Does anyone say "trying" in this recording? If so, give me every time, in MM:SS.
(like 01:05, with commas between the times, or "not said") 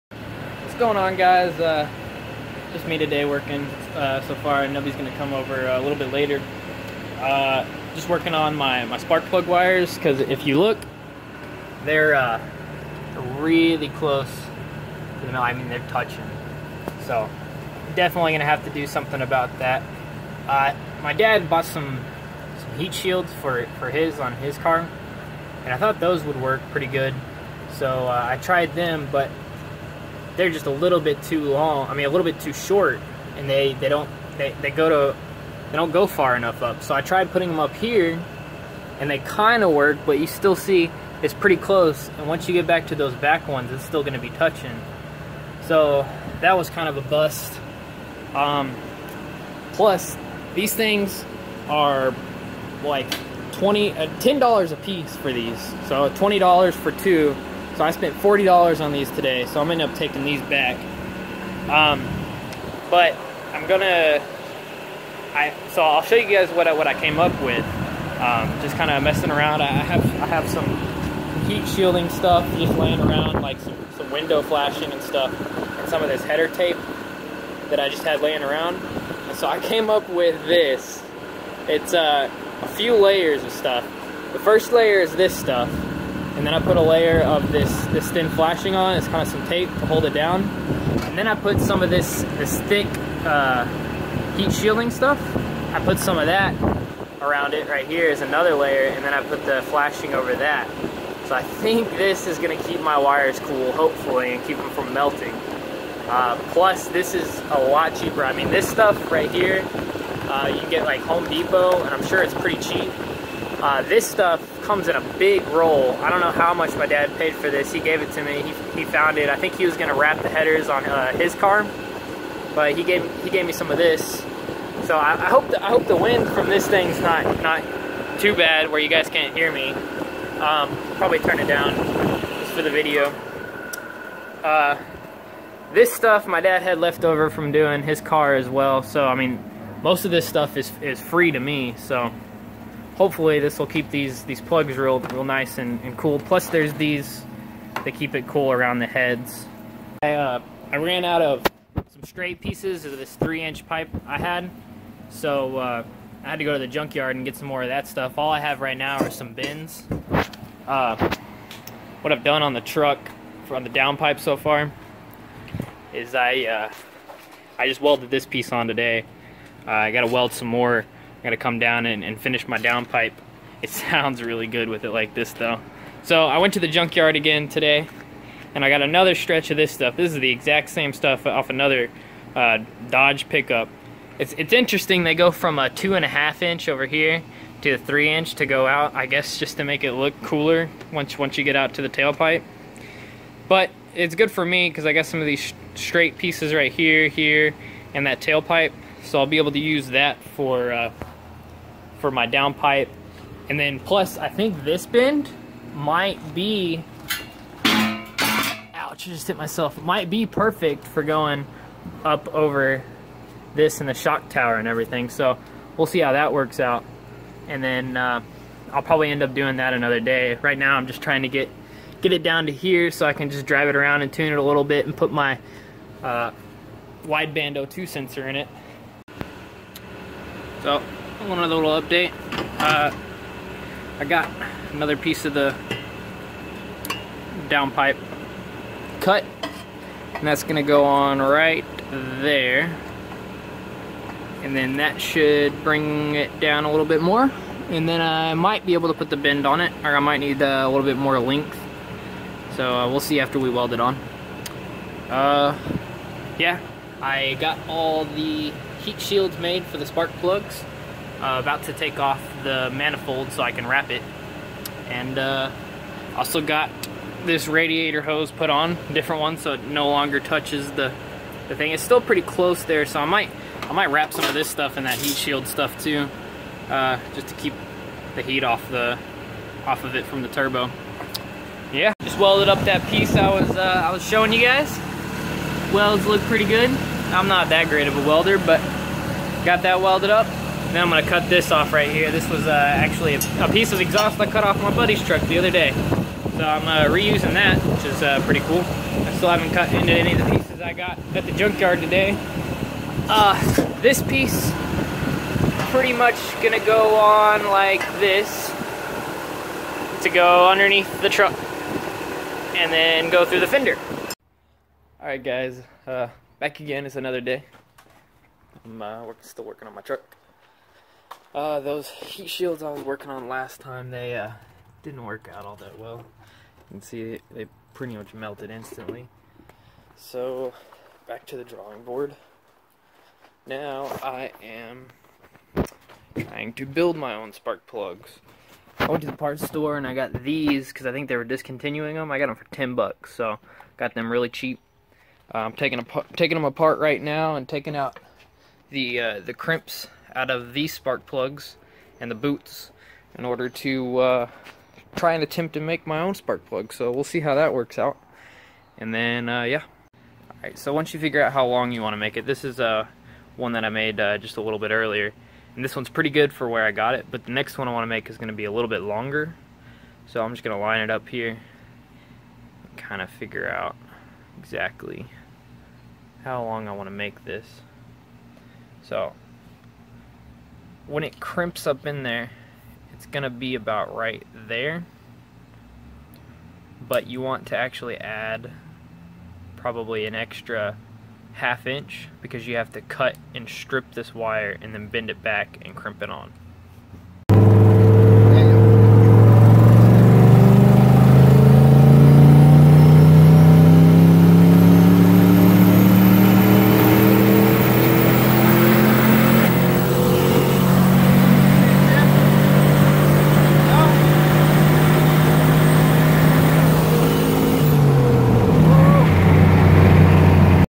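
03:41, 05:36.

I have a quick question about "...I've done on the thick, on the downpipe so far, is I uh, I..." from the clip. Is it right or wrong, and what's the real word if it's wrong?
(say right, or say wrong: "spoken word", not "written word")
wrong: "truck", not "thick".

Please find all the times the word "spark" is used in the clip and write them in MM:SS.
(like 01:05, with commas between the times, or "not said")
00:08, 04:19, 05:37, 05:50, 05:56.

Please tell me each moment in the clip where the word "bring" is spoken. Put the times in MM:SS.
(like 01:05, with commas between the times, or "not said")
04:05.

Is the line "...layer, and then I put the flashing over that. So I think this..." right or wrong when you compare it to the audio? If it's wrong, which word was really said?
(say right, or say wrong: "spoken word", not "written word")
right.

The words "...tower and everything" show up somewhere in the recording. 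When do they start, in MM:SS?
03:34.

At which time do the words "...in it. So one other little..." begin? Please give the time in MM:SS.
03:48.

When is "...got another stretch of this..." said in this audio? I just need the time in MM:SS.
02:58.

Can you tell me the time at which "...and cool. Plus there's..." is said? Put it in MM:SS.
02:25.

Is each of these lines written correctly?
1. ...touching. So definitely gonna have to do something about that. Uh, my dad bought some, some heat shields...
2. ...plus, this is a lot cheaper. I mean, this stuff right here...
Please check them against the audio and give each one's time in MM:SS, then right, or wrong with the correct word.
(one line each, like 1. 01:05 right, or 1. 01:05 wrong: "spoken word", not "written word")
1. 00:15 right
2. 01:46 right.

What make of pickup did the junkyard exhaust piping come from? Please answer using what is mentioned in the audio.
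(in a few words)
Dodge.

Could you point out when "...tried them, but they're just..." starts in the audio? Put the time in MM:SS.
00:28.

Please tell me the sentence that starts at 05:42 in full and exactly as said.
I got them for 10 bucks, so got them really cheap.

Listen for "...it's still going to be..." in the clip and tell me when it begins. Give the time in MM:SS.
00:43.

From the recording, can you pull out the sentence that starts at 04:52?
This was uh, actually a, a, piece of exhaust I cut off my buddy's truck the other day.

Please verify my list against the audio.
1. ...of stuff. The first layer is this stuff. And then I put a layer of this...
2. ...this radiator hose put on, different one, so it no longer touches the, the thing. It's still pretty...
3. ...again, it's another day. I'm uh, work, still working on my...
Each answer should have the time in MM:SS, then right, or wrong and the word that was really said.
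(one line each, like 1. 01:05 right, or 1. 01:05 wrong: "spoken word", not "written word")
1. 01:23 right
2. 04:27 right
3. 05:16 right.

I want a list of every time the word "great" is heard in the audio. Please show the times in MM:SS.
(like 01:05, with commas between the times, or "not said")
04:47.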